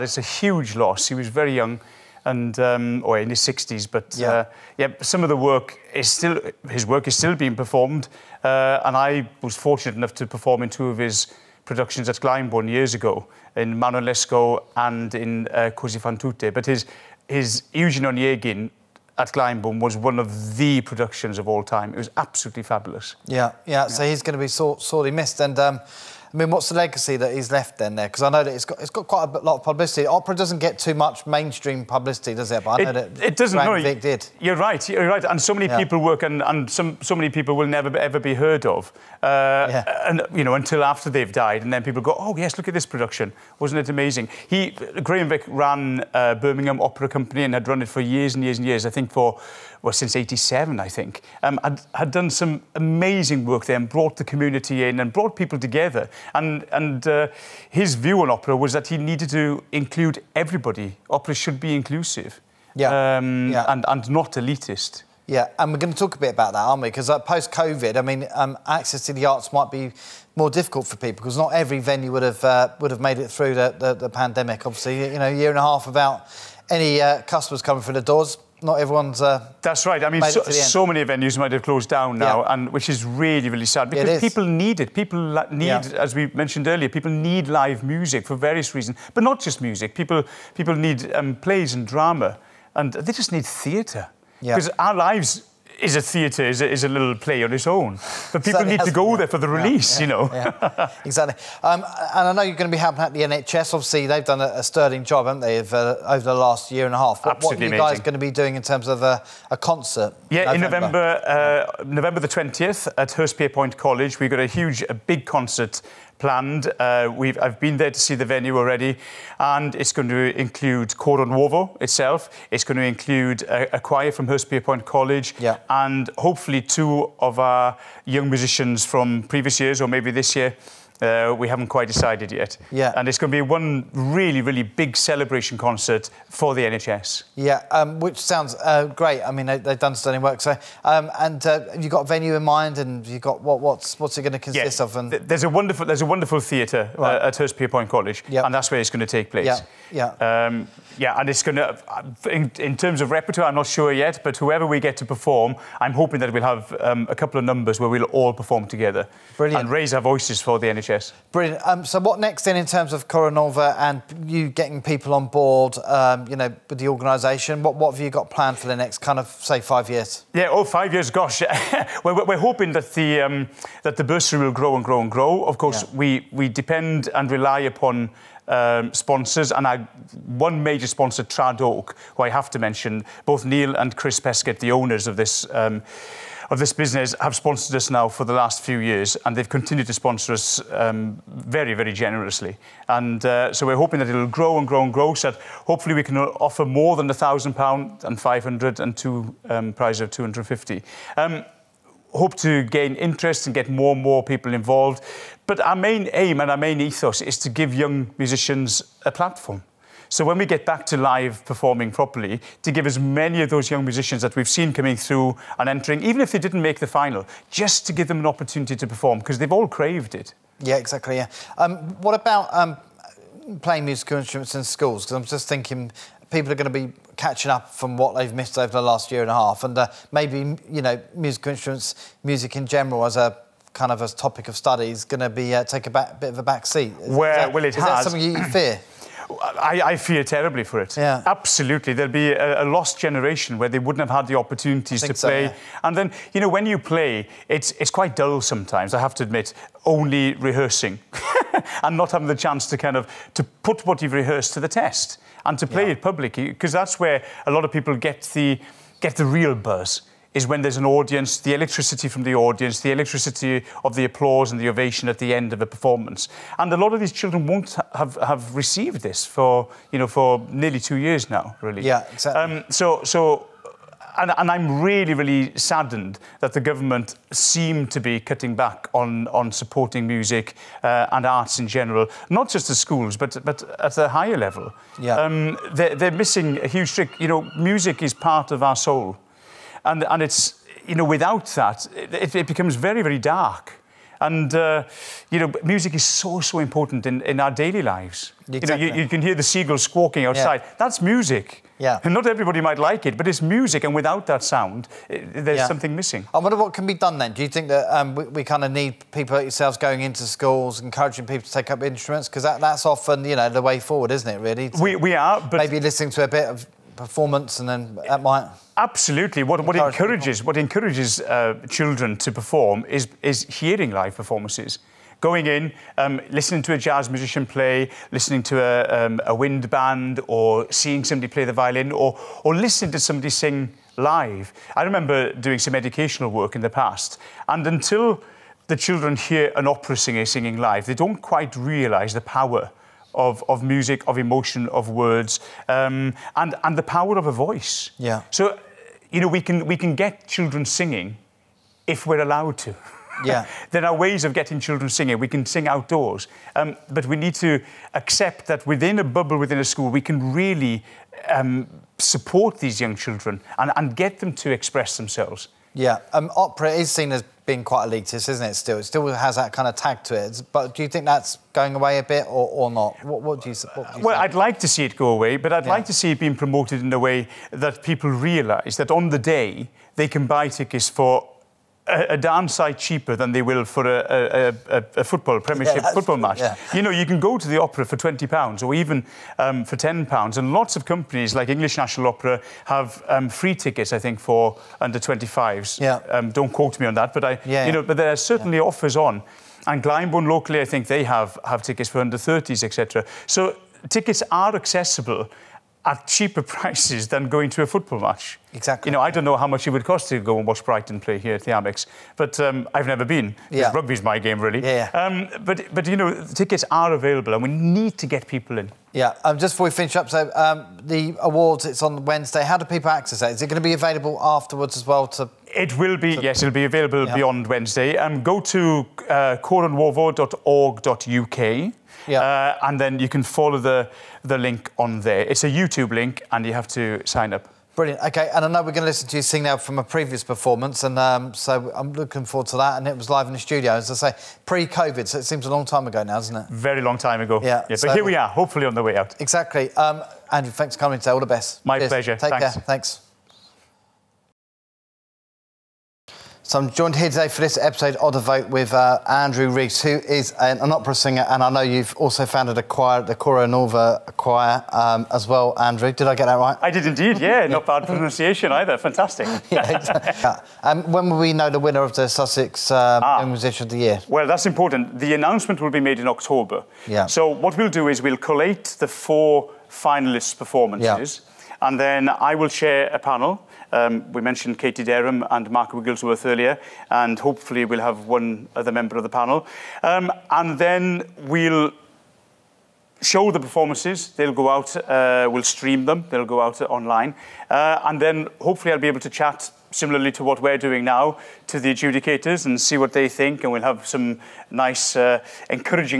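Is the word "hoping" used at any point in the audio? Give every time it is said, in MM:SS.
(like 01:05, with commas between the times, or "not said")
02:35, 02:52, 03:13.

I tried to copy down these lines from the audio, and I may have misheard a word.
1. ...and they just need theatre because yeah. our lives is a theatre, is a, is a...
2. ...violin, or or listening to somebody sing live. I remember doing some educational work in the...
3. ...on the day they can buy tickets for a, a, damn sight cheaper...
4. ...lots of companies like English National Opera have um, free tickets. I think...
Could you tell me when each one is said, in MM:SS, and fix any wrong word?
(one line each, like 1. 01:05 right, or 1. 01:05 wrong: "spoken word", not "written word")
1. 01:32 right
2. 05:31 right
3. 06:18 right
4. 06:30 right.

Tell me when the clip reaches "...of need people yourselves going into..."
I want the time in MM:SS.
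05:08.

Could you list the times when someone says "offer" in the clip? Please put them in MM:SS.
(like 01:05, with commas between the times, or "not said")
03:16, 06:38.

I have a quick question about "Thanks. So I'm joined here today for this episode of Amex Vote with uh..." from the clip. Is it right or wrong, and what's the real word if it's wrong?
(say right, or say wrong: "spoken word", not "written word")
wrong: "The", not "Amex".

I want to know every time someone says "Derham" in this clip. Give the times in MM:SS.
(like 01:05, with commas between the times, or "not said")
08:04.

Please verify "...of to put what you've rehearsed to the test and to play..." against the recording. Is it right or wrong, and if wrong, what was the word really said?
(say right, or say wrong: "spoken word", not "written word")
right.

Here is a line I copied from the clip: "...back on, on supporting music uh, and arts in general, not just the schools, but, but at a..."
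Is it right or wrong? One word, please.
right.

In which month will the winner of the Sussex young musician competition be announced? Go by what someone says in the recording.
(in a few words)
October.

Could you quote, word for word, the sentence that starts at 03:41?
Um, what about um, playing musical instruments in schools?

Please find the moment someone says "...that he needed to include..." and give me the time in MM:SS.
00:58.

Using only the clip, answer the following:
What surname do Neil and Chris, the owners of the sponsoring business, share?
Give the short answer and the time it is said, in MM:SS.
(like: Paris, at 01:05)
Peskett, at 03:04.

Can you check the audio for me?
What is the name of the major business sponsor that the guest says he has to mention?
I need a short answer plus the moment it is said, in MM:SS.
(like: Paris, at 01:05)
Tradoc, at 03:01.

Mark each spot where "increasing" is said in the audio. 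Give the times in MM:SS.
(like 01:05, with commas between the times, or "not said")
not said.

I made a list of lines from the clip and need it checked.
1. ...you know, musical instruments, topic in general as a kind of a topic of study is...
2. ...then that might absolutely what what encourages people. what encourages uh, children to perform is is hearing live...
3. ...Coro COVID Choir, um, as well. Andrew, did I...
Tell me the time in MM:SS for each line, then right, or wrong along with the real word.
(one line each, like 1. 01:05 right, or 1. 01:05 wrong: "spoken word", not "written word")
1. 03:50 wrong: "music", not "topic"
2. 05:17 right
3. 07:43 wrong: "Nuovo", not "COVID".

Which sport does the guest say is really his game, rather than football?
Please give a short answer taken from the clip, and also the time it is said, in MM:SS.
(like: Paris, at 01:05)
Rugby, at 06:53.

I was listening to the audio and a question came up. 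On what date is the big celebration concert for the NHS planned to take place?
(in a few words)
November 20th.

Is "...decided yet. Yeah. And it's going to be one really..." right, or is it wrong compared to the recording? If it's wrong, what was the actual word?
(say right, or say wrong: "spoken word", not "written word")
right.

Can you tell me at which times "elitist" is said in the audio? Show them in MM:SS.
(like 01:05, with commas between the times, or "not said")
01:04, 06:07.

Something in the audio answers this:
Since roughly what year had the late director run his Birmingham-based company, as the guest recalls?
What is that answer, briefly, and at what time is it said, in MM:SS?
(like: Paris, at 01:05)
1987, at 00:50.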